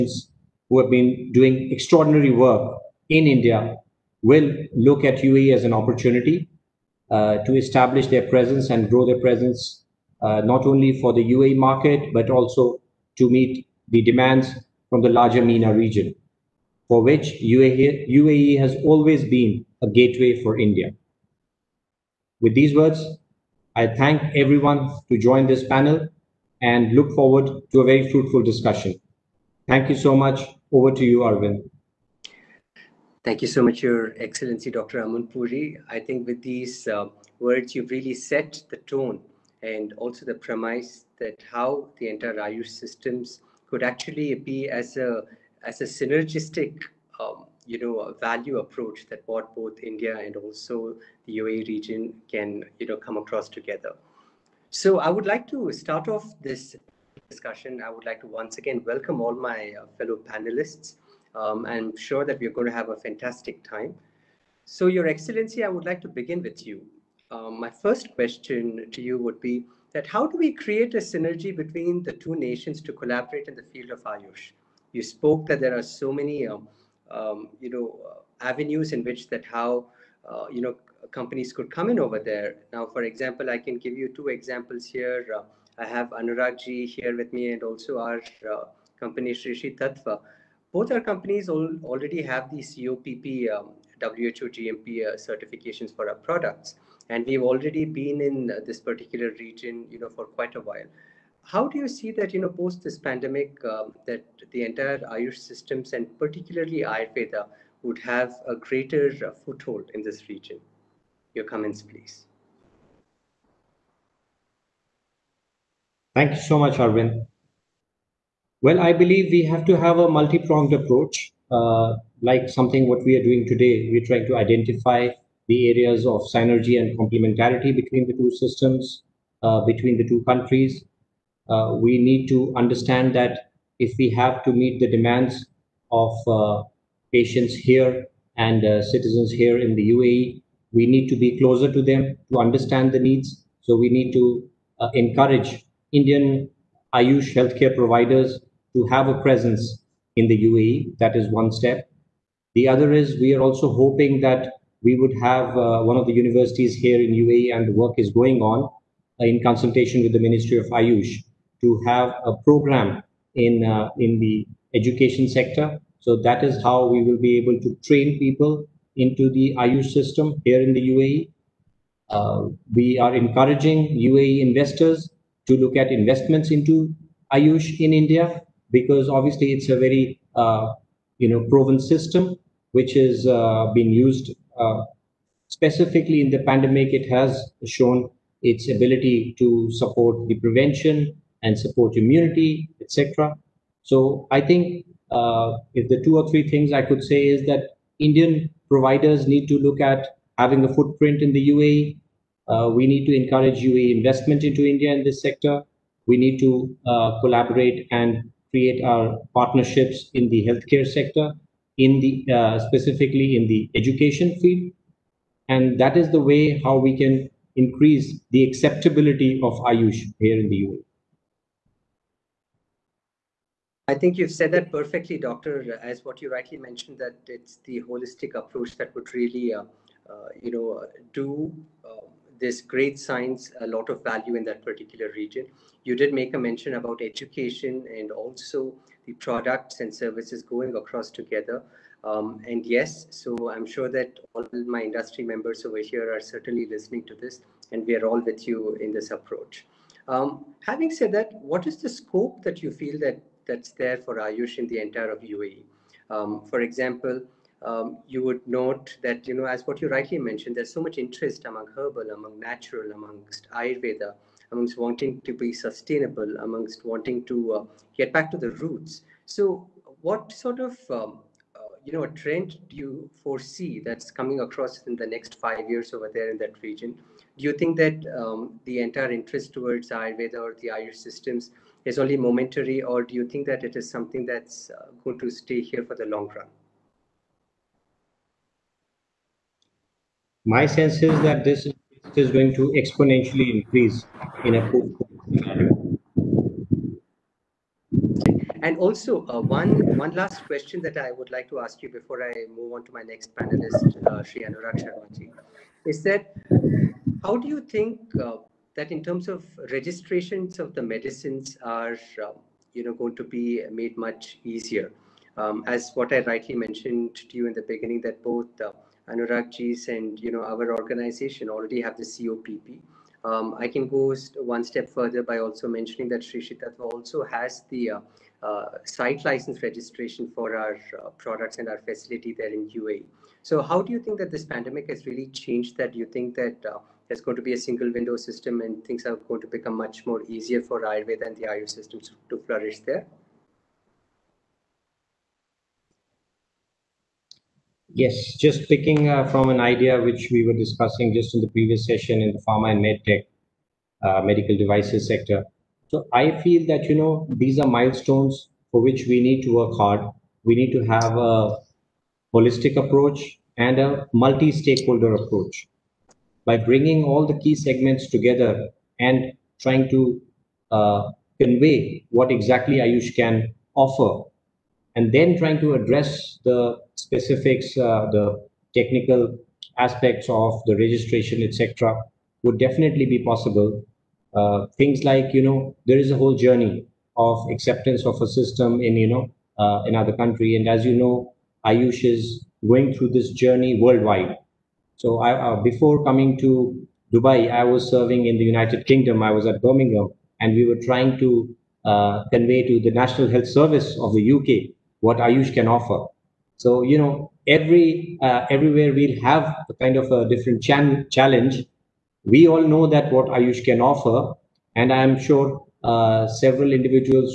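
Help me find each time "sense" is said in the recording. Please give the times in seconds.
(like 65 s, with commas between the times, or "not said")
290 s.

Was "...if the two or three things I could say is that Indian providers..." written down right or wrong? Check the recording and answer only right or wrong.
right.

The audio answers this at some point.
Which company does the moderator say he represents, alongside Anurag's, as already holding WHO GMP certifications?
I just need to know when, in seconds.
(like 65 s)
89 s.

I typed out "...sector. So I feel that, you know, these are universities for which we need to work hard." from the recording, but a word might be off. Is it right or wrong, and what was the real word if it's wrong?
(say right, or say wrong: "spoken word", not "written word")
wrong: "milestones", not "universities".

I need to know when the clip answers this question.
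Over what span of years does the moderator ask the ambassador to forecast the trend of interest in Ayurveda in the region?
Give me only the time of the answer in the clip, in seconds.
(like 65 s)
275 s.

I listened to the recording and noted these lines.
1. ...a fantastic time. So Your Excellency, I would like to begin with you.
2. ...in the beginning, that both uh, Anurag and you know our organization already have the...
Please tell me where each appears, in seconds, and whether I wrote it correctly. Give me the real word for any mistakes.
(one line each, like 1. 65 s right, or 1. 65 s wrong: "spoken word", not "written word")
1. 62 s right
2. 317 s right.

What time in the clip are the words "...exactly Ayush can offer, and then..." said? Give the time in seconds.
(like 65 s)
372 s.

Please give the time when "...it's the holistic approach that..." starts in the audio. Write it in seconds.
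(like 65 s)
227 s.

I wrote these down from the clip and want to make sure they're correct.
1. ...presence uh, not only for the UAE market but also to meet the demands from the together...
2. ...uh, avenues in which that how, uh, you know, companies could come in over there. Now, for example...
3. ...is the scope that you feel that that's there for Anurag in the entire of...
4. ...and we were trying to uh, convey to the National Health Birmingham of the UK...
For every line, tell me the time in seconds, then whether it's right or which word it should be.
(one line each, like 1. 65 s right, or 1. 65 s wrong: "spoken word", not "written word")
1. 9 s wrong: "larger", not "together"
2. 78 s right
3. 251 s wrong: "Ayush", not "Anurag"
4. 400 s wrong: "Service", not "Birmingham".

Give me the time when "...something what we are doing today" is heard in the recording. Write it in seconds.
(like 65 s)
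122 s.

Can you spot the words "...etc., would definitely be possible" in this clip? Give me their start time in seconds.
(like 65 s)
381 s.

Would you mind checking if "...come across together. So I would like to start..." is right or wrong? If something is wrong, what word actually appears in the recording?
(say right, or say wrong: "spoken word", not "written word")
right.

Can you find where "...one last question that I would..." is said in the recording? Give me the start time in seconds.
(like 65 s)
299 s.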